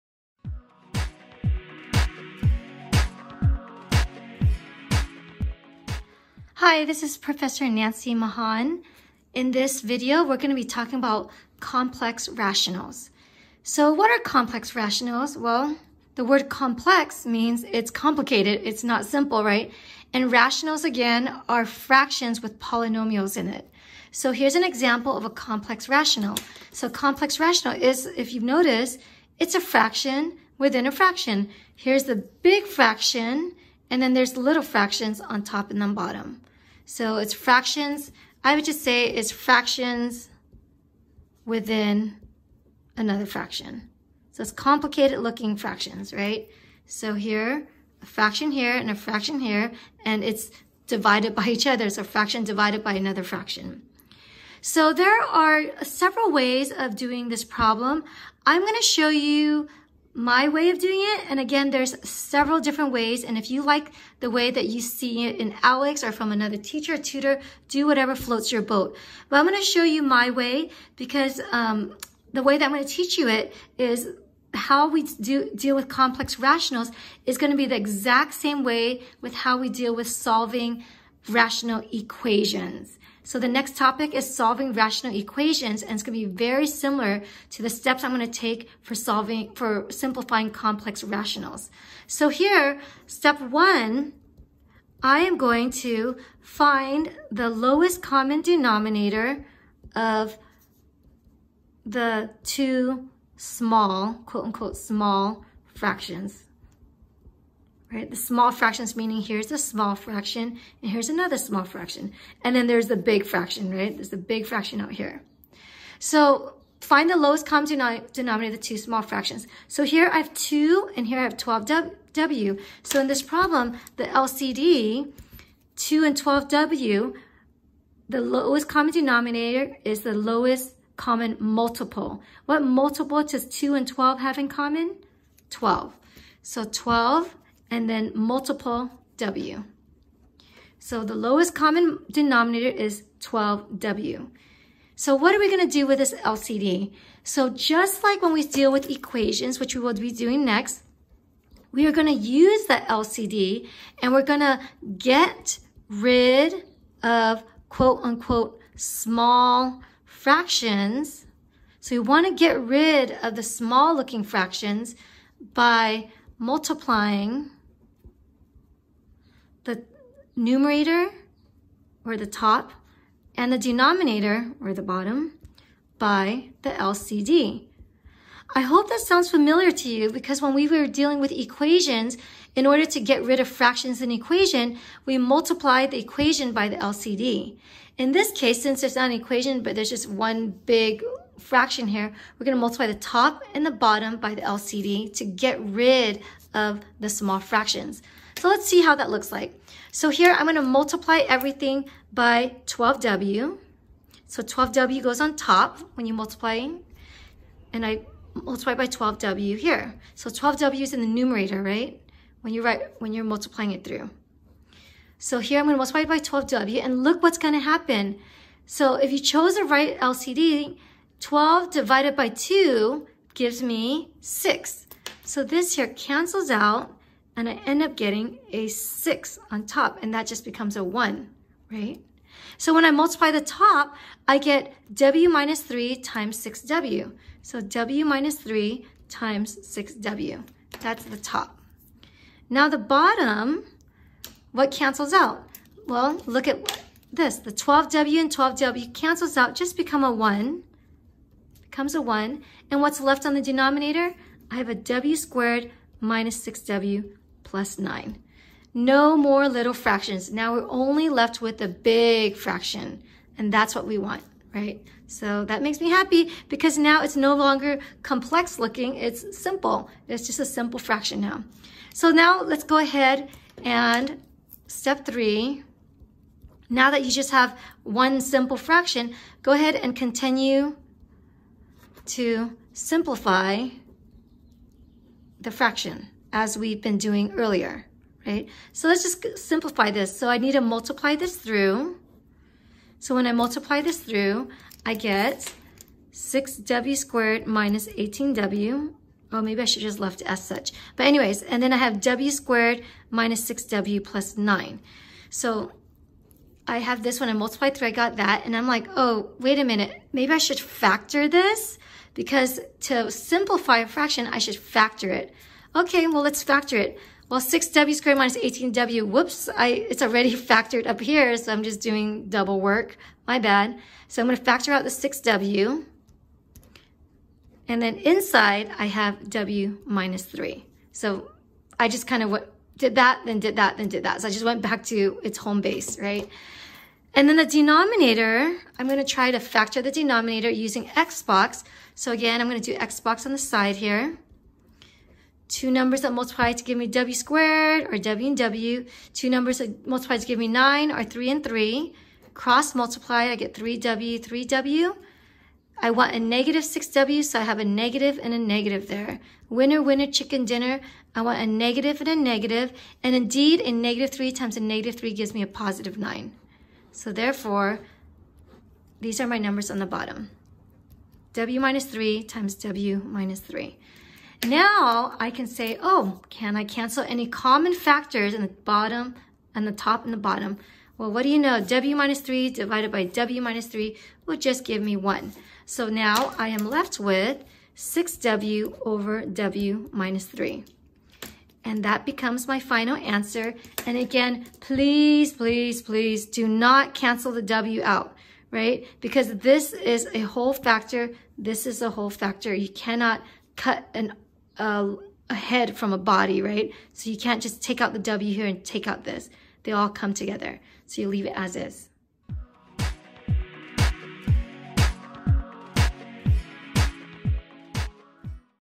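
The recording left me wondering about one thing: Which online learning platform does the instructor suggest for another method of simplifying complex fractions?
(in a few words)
ALEKS.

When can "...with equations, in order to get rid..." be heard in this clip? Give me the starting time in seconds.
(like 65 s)
181 s.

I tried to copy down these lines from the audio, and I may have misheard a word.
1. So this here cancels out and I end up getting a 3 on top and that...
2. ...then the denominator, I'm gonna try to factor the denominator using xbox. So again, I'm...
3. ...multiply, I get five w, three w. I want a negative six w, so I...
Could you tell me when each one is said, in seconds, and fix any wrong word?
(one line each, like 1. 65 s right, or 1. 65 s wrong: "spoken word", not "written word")
1. 225 s wrong: "6", not "3"
2. 337 s right
3. 352 s wrong: "three", not "five".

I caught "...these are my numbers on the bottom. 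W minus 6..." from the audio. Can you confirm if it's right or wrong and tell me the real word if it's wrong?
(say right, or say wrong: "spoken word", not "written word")
wrong: "3", not "6".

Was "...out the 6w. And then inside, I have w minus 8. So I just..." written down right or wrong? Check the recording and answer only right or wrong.
wrong.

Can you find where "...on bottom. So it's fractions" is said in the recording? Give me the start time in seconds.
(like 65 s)
35 s.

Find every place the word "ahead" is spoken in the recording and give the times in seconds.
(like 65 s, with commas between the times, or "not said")
272 s, 279 s.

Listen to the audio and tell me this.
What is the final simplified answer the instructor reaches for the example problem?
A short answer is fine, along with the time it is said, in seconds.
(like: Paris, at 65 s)
6W over W minus 3, at 387 s.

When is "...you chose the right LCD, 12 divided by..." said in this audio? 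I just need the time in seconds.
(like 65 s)
219 s.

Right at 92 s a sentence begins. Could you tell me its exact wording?
So here, step one, I am going to find the lowest common denominator of the two small, quote unquote, small fractions right?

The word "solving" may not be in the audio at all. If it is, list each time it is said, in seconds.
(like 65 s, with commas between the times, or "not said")
80 s, 84 s, 88 s.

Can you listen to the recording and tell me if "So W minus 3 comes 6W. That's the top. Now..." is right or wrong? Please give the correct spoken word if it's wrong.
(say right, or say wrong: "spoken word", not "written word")
wrong: "times", not "comes".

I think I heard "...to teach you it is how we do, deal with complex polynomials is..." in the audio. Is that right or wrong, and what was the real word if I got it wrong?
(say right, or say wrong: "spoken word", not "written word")
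wrong: "rationals", not "polynomials".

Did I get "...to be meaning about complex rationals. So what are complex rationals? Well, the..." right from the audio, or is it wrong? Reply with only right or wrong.
wrong.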